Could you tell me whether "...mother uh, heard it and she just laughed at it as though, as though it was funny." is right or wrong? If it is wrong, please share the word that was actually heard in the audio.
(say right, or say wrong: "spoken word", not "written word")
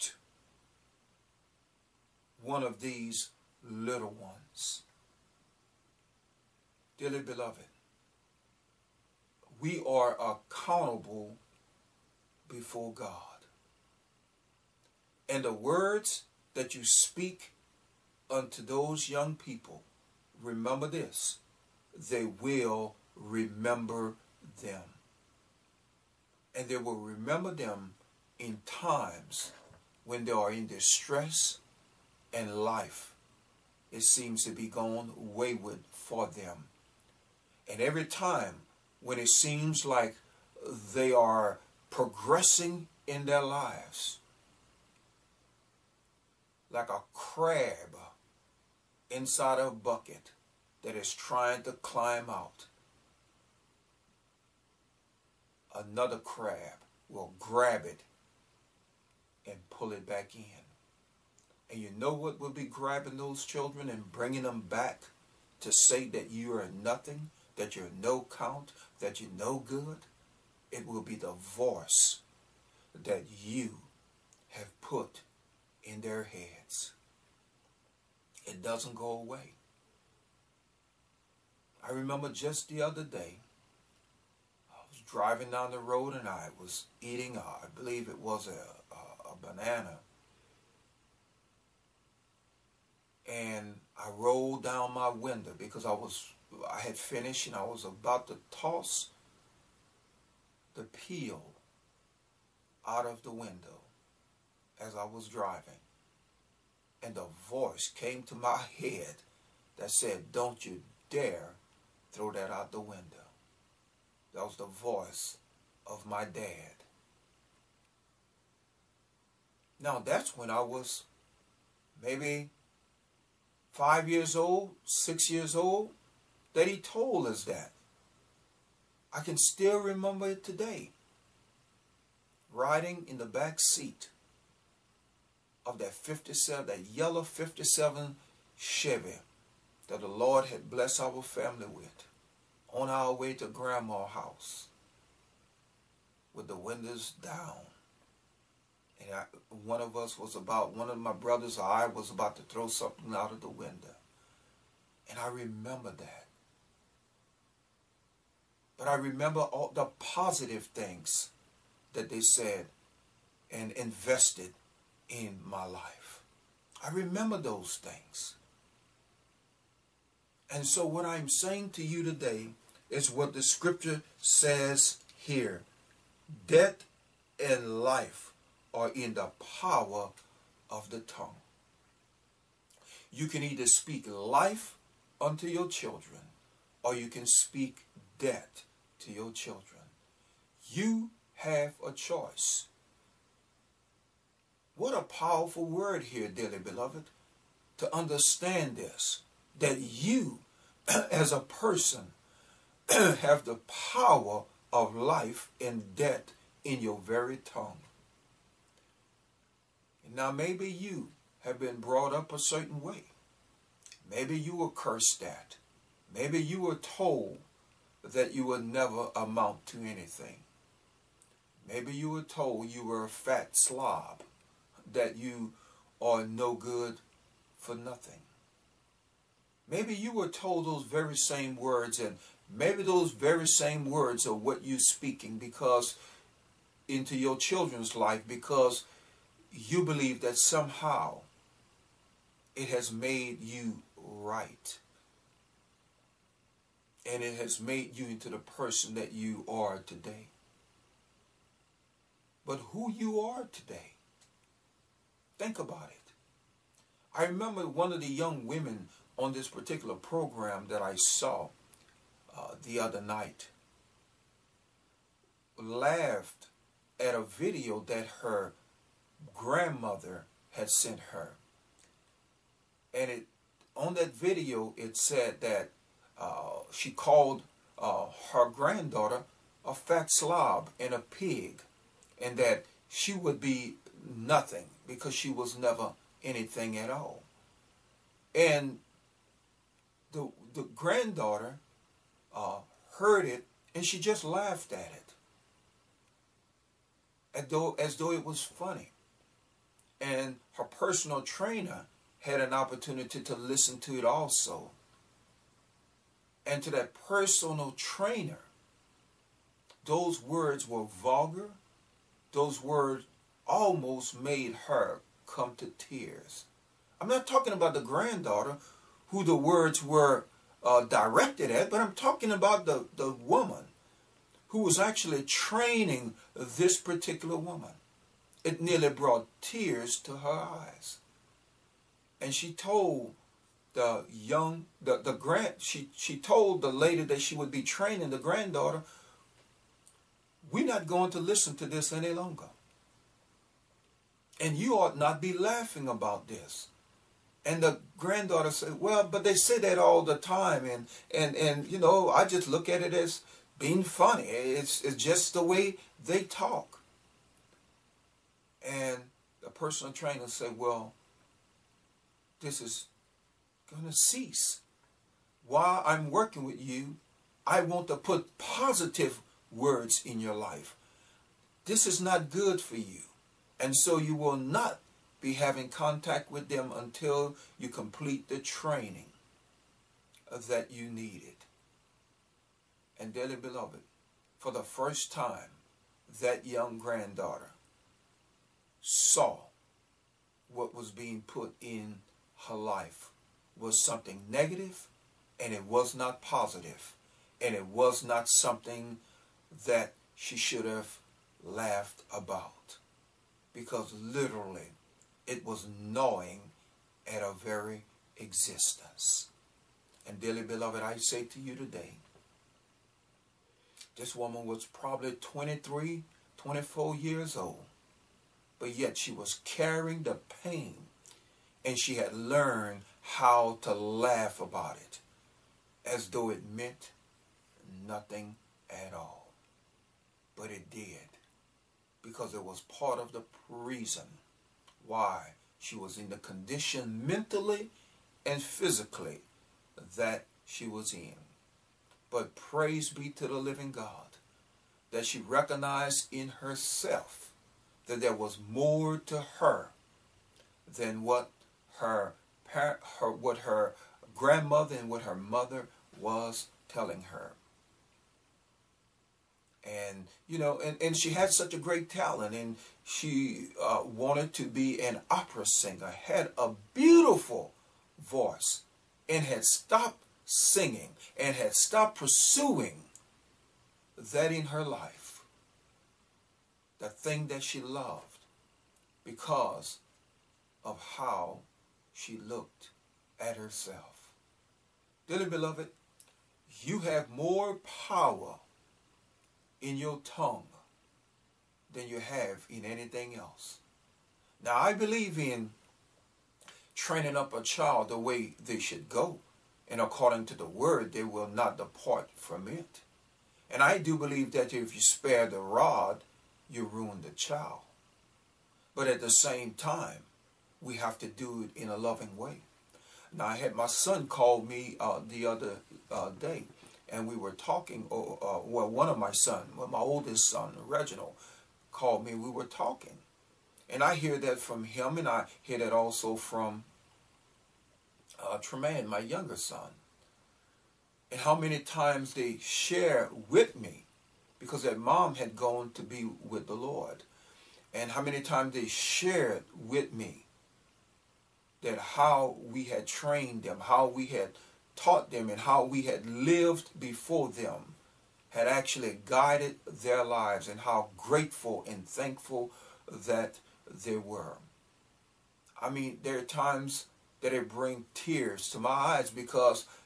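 wrong: "granddaughter", not "mother".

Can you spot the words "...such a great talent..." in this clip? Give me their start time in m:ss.
7:41.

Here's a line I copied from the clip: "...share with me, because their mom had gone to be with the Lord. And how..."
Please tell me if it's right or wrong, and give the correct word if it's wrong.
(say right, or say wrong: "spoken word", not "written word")
right.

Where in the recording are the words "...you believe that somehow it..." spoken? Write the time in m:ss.
3:59.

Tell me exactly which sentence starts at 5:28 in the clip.
It nearly brought tears to her eyes.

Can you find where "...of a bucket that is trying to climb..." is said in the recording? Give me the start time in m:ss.
0:49.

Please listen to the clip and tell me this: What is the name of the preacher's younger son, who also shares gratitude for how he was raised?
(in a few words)
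Tremaine.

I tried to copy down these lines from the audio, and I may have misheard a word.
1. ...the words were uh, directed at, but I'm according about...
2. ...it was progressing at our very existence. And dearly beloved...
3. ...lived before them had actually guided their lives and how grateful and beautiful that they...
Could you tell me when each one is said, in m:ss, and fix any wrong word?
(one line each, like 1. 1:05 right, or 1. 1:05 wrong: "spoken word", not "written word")
1. 5:19 wrong: "talking", not "according"
2. 6:45 wrong: "gnawing", not "progressing"
3. 9:06 wrong: "thankful", not "beautiful".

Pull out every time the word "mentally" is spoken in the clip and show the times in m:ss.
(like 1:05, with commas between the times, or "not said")
7:17.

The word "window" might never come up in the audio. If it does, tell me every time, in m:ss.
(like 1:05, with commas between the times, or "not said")
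1:35, 1:43, 1:52, 2:26, 2:33.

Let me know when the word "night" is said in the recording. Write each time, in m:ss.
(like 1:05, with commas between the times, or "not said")
4:23.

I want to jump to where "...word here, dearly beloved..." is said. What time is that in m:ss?
3:15.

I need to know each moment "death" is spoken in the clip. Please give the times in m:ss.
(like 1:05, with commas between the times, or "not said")
2:56, 3:08, 3:25.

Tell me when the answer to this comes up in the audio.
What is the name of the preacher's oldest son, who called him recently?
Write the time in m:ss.
8:40.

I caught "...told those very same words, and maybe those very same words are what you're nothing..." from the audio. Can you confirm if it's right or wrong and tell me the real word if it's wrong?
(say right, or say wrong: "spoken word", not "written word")
wrong: "speaking", not "nothing".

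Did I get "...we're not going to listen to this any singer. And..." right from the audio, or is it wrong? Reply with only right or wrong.
wrong.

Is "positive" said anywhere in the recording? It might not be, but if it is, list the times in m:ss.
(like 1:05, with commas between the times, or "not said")
2:39, 6:08, 6:36.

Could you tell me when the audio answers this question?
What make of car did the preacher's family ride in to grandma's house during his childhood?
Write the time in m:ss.
2:18.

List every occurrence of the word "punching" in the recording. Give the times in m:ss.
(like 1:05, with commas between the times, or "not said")
not said.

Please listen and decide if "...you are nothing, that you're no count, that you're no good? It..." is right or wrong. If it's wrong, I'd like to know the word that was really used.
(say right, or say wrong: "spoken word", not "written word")
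right.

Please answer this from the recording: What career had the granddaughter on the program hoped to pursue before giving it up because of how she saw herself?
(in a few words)
Opera singer.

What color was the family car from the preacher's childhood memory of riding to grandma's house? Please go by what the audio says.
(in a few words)
Yellow.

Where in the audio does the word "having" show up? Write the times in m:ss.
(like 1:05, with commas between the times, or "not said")
6:15.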